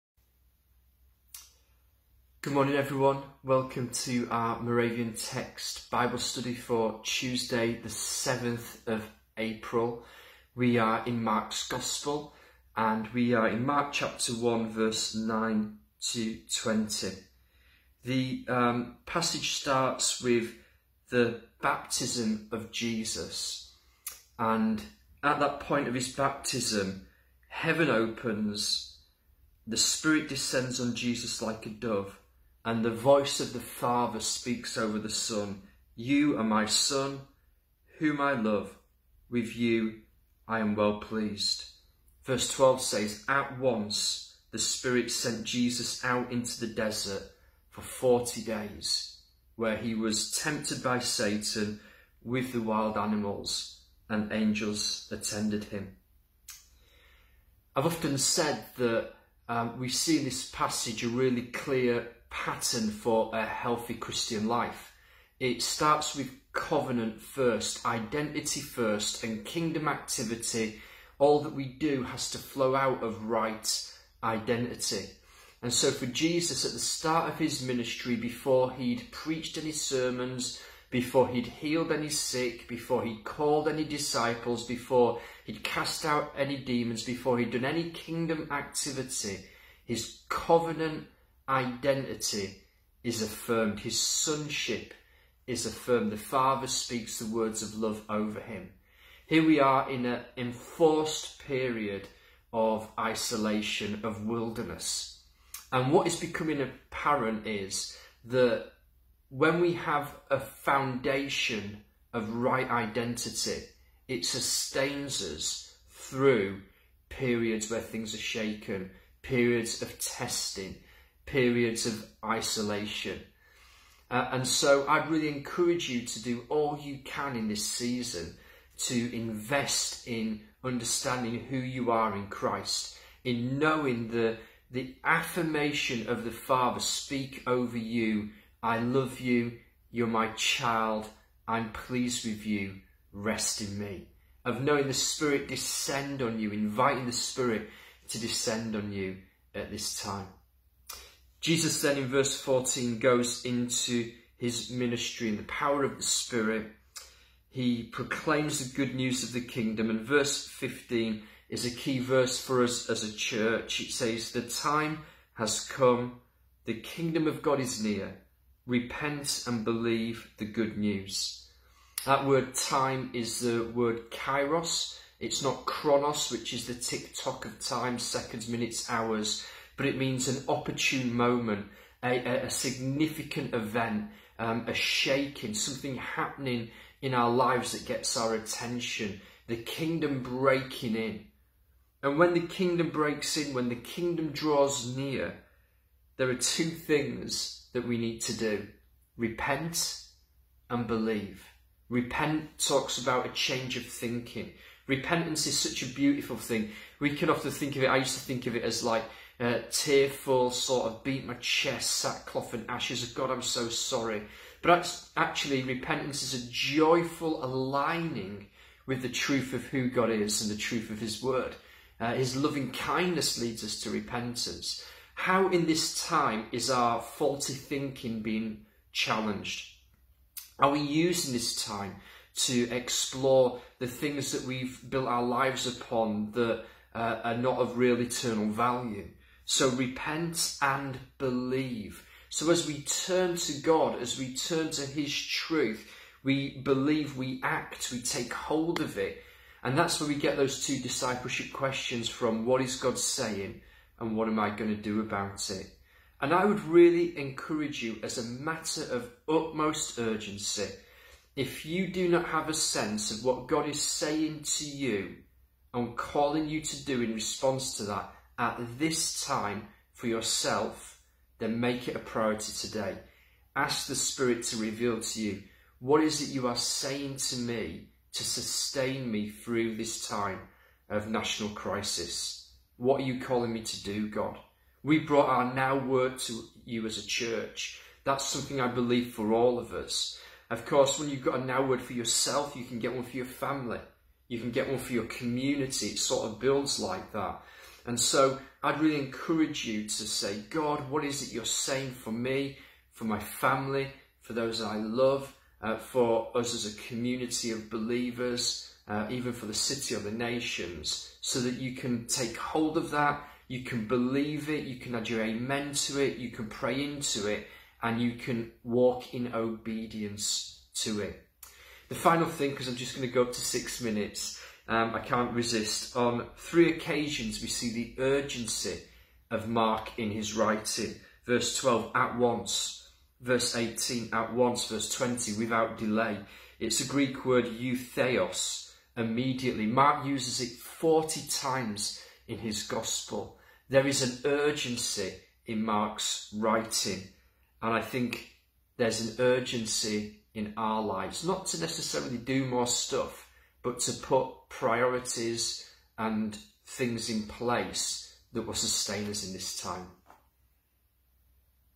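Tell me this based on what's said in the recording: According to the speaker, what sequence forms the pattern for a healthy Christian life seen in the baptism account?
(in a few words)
Covenant first, identity first.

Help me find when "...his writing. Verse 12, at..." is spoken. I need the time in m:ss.
5:30.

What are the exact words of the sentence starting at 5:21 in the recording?
The final thing, because I'm just going to go up to six minutes, um, I can't resist.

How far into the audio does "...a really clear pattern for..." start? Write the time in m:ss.
1:01.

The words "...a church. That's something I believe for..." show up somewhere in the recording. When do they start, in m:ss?
4:46.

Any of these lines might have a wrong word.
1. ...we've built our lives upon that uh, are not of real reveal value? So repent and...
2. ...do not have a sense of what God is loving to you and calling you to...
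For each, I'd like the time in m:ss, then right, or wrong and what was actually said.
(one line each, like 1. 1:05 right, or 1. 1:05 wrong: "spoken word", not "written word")
1. 3:54 wrong: "eternal", not "reveal"
2. 4:21 wrong: "saying", not "loving".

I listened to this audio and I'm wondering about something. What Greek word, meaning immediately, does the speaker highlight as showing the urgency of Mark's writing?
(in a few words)
Eutheos.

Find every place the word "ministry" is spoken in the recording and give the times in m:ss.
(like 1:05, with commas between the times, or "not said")
1:17, 2:34.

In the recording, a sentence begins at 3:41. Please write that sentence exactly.
Uh, his loving kindness leads us to repentance.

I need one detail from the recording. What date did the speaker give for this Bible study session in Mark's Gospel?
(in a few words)
7th of April.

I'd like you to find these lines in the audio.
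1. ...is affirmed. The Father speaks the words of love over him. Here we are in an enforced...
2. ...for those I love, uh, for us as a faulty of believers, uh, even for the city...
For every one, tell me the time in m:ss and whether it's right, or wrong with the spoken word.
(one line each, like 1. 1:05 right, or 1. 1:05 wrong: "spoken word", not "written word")
1. 1:35 right
2. 5:04 wrong: "community", not "faulty".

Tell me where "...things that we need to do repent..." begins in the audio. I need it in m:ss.
3:16.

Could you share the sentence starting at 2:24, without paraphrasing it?
Of knowing the Spirit descend on you, inviting the Spirit to descend on you at this time.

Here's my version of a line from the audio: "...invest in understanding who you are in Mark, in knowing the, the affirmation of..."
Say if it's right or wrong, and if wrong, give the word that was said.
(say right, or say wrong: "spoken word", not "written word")
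wrong: "Christ", not "Mark".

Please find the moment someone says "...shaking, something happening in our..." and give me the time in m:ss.
3:04.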